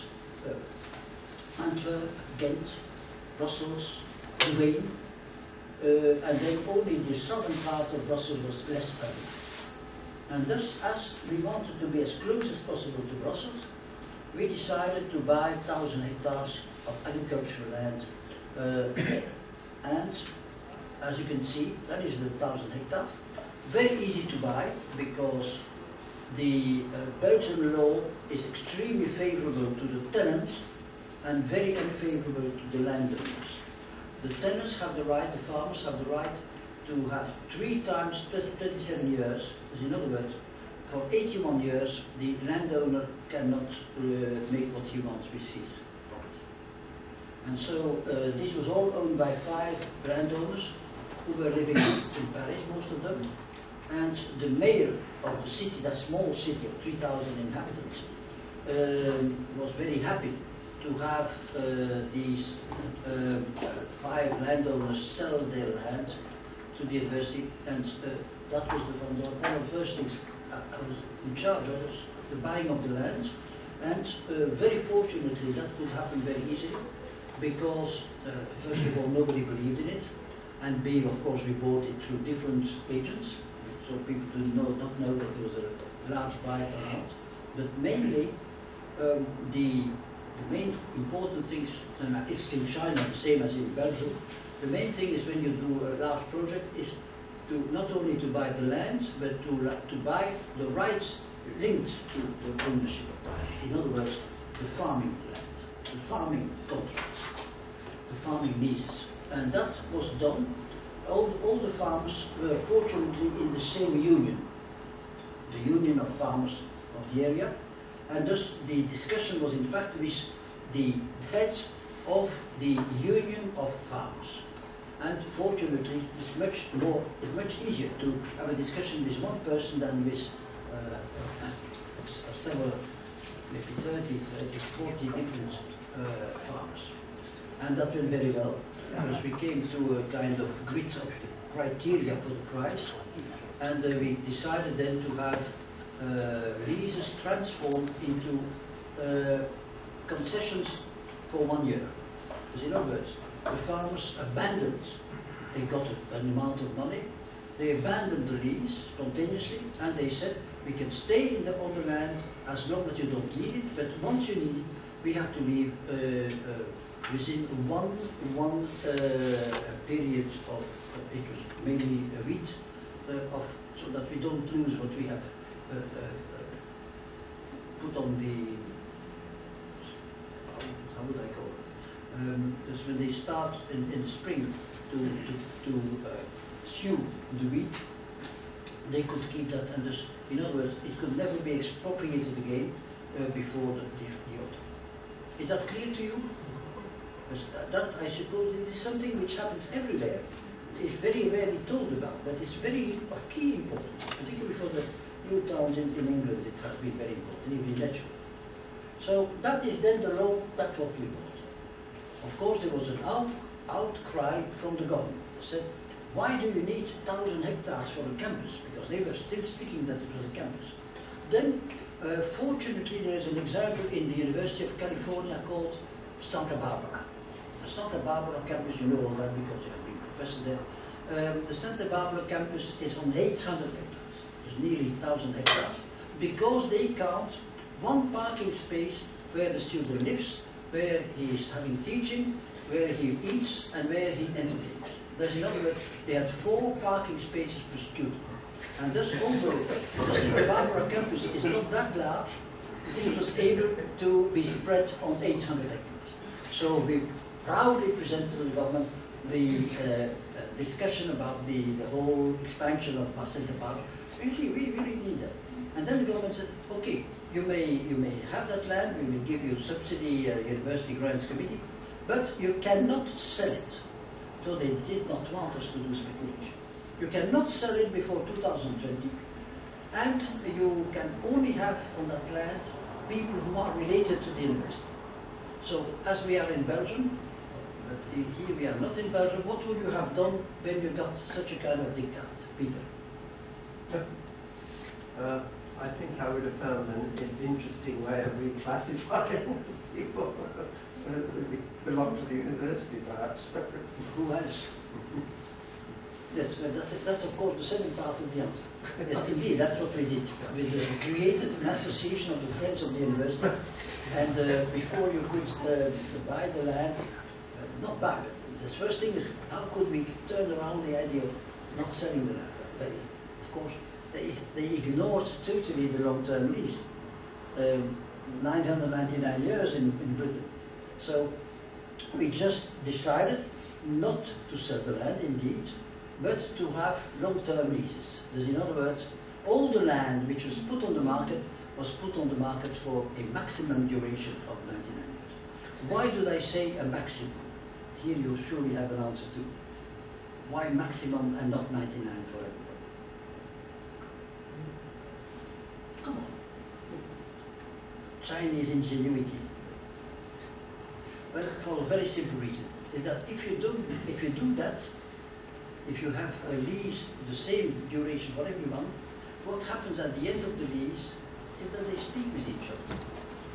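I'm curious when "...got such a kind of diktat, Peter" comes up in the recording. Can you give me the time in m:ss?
4:50.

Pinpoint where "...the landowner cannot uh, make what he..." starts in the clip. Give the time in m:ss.
0:42.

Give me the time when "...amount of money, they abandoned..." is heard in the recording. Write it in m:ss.
2:36.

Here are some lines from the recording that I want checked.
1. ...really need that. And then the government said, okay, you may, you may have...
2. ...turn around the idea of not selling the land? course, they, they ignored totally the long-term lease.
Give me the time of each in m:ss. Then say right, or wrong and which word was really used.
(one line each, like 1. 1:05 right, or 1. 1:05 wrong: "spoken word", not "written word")
1. 4:24 right
2. 5:20 right.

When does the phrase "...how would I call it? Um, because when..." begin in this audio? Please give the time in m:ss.
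3:00.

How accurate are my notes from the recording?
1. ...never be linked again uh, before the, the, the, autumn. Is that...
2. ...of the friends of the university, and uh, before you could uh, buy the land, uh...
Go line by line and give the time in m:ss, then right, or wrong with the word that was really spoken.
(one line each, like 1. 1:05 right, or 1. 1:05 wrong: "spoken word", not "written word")
1. 3:11 wrong: "expropriated", not "linked"
2. 5:12 right.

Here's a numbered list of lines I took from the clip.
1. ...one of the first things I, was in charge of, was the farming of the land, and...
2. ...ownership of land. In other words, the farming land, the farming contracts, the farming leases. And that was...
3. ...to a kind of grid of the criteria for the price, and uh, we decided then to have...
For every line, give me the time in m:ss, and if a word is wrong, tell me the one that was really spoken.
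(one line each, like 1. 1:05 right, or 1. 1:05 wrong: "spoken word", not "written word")
1. 1:09 wrong: "buying", not "farming"
2. 1:42 right
3. 2:19 right.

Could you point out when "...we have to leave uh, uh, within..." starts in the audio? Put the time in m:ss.
2:45.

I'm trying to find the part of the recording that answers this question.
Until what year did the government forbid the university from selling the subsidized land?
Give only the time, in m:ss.
4:38.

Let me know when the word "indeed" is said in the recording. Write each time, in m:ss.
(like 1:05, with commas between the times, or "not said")
5:09, 5:35.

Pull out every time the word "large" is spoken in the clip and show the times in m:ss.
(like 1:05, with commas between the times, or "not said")
1:26, 1:36, 4:11.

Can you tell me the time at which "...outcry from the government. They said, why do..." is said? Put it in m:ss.
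3:33.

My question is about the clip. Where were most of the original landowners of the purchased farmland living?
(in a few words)
Paris.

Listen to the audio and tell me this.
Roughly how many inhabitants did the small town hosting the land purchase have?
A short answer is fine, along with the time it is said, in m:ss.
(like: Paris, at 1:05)
3,000, at 0:56.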